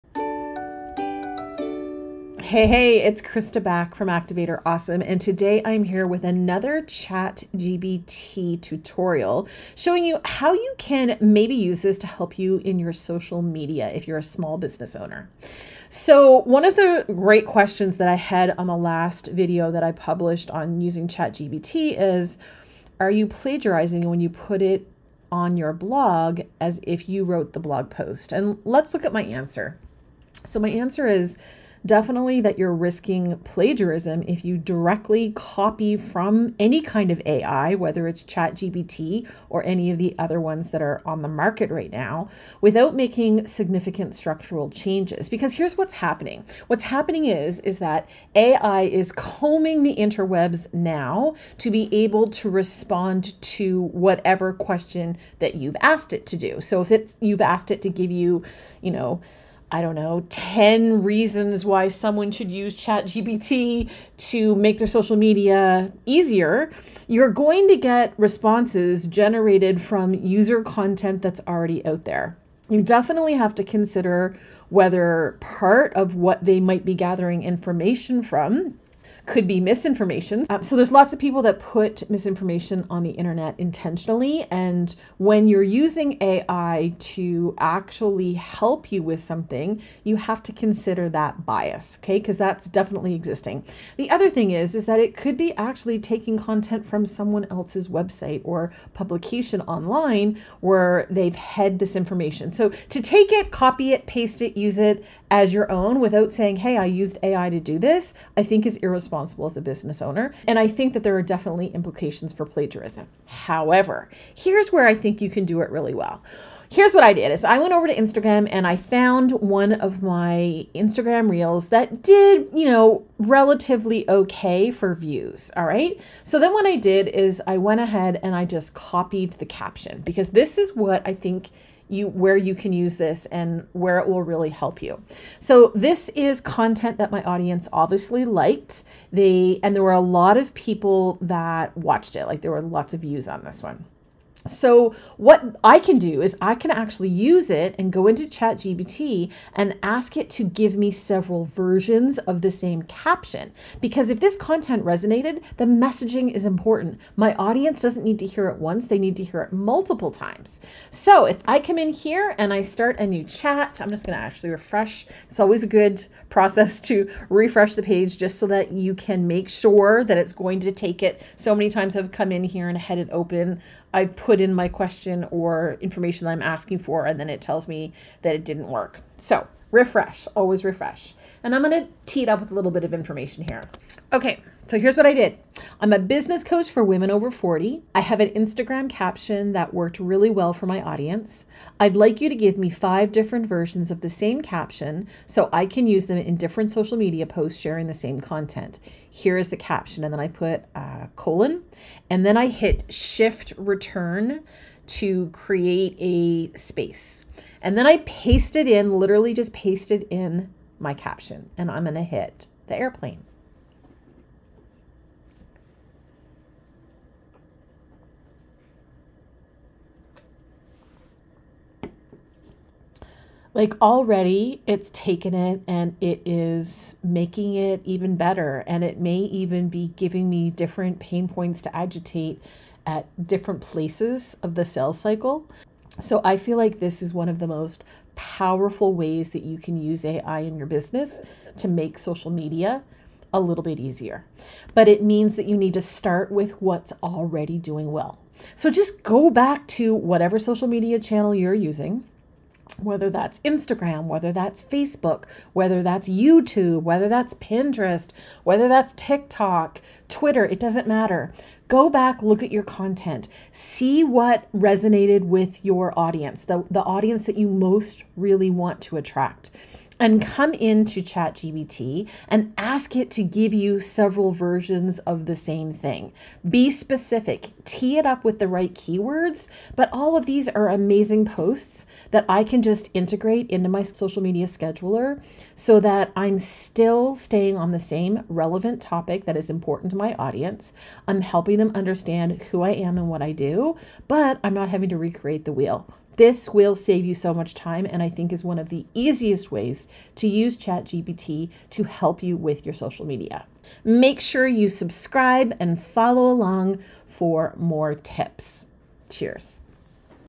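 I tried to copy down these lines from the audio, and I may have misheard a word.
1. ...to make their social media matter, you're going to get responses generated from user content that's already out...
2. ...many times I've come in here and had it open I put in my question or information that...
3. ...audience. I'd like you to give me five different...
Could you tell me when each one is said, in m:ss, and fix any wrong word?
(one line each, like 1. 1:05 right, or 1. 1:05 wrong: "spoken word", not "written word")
1. 1:04 wrong: "easier", not "matter"
2. 2:51 right
3. 3:10 right.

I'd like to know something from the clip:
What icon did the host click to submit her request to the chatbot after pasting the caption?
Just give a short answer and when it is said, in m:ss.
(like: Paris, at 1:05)
the airplane, at 3:32.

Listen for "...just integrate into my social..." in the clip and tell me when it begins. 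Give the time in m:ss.
4:42.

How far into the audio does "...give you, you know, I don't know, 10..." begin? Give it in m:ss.
0:57.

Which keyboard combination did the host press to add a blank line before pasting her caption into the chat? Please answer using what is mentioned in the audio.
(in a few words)
shift return.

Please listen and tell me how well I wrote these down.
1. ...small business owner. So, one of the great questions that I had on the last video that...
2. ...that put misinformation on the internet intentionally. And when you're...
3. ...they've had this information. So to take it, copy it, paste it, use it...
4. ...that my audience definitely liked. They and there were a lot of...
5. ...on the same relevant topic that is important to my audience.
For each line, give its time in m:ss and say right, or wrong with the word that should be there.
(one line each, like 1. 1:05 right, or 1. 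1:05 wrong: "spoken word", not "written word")
1. 0:14 right
2. 1:21 right
3. 1:41 right
4. 2:16 wrong: "obviously", not "definitely"
5. 4:47 right.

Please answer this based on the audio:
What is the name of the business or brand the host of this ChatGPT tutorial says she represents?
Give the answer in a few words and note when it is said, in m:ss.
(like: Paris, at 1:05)
Activate Her Awesome, at 0:04.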